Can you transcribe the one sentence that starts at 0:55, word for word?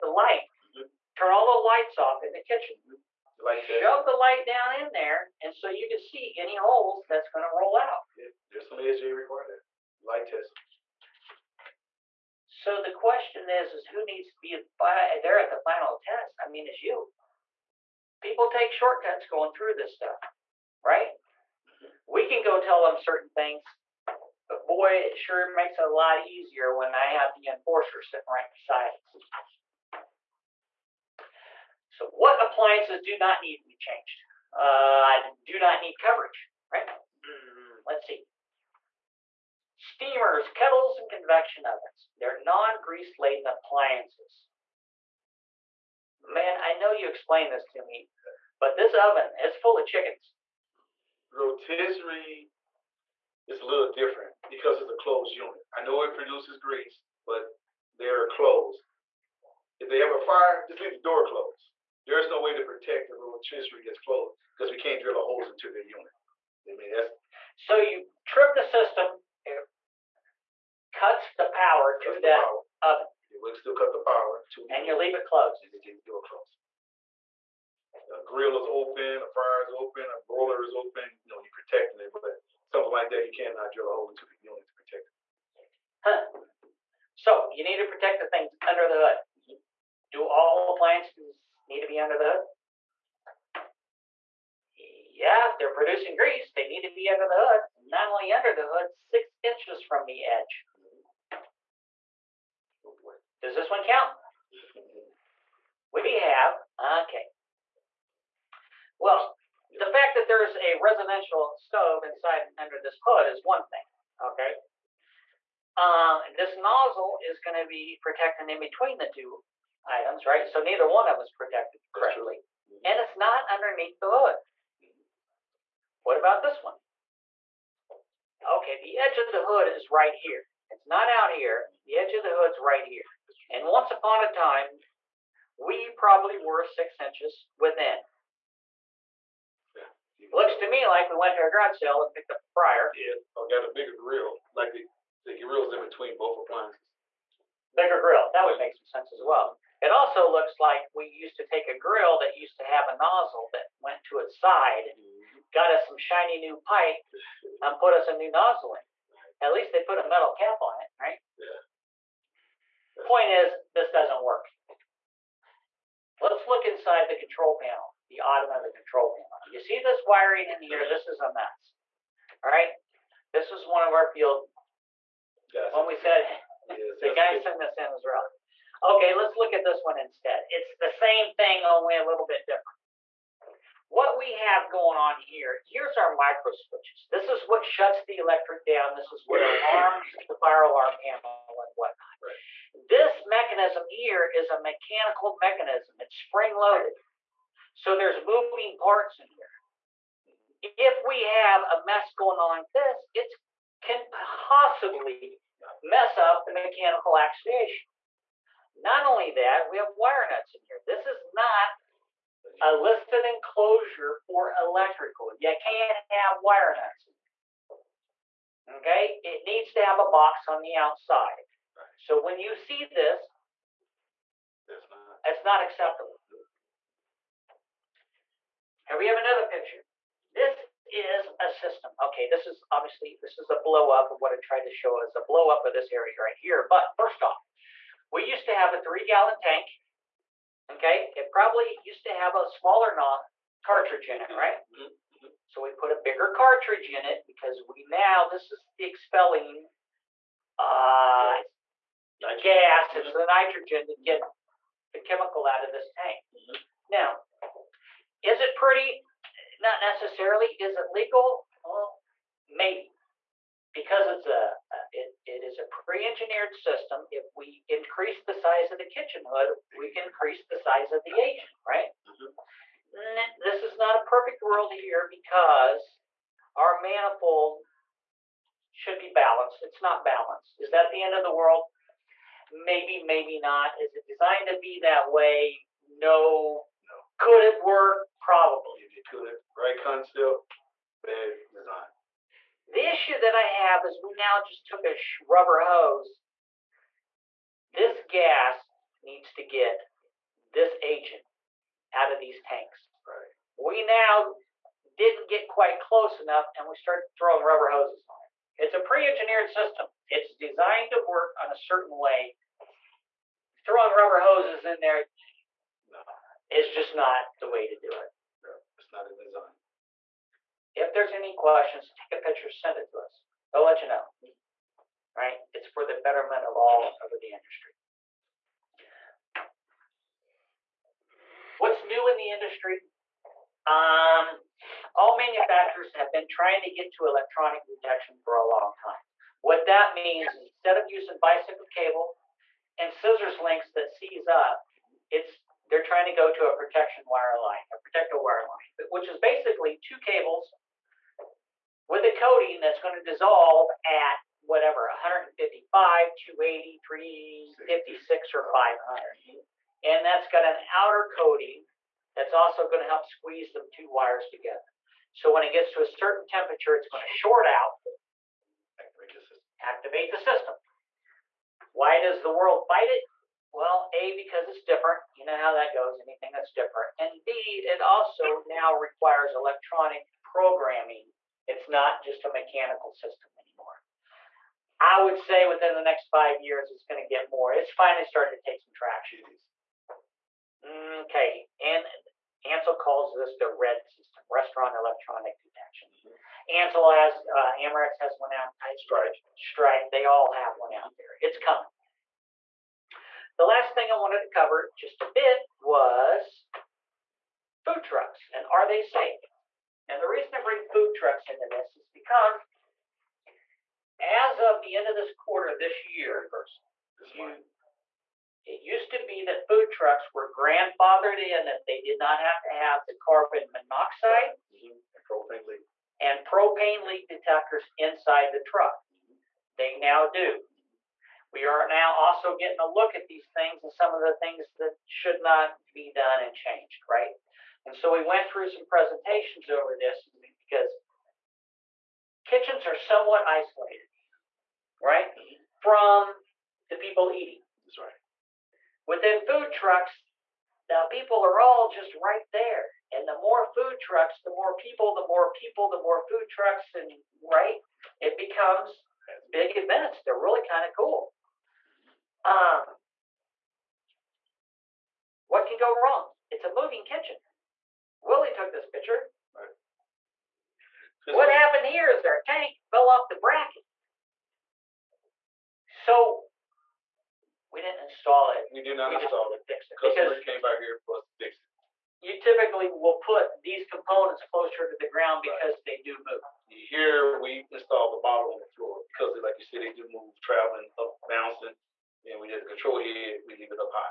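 I know it produces grease, but they're closed.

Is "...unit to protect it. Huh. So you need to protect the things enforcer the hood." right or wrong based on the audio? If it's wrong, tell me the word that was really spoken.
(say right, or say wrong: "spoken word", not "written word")
wrong: "under", not "enforcer".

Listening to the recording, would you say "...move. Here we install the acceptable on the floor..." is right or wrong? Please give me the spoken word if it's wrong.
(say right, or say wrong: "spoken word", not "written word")
wrong: "bottle", not "acceptable".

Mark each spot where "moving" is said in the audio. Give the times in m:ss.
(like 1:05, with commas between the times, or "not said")
3:18, 7:46.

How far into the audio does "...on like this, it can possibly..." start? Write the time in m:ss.
3:22.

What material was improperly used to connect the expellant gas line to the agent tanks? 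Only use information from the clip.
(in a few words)
rubber hose.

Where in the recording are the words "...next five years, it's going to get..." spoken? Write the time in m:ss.
6:25.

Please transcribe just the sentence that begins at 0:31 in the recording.
So what appliances do not need to be changed?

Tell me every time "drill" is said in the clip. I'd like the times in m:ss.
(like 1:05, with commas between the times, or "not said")
1:05, 1:23.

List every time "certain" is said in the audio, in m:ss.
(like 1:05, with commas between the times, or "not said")
0:22, 5:11, 6:05.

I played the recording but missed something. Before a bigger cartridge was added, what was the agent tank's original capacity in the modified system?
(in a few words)
3 gallon.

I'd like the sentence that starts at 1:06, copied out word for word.
I mean, that's so you trip the system it cuts the power cuts to the that power.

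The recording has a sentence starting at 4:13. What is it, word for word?
the nitrogen to get the chemical out of this tank.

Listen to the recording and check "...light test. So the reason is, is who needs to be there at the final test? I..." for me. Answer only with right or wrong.
wrong.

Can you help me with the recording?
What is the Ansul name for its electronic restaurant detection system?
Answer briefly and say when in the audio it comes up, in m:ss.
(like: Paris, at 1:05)
RED, at 6:33.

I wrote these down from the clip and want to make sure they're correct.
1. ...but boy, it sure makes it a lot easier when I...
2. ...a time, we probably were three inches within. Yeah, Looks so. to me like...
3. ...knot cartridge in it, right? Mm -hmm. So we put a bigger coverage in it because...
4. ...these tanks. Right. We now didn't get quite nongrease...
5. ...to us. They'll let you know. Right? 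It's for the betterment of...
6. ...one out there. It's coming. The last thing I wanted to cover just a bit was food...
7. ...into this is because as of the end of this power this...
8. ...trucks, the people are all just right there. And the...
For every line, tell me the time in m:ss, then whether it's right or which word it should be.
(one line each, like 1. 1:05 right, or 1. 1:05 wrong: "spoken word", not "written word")
1. 0:24 right
2. 2:14 wrong: "six", not "three"
3. 4:02 wrong: "cartridge", not "coverage"
4. 5:02 wrong: "close", not "nongrease"
5. 5:22 right
6. 6:40 right
7. 6:51 wrong: "quarter", not "power"
8. 7:29 right.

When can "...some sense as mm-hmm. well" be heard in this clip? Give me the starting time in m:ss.
2:28.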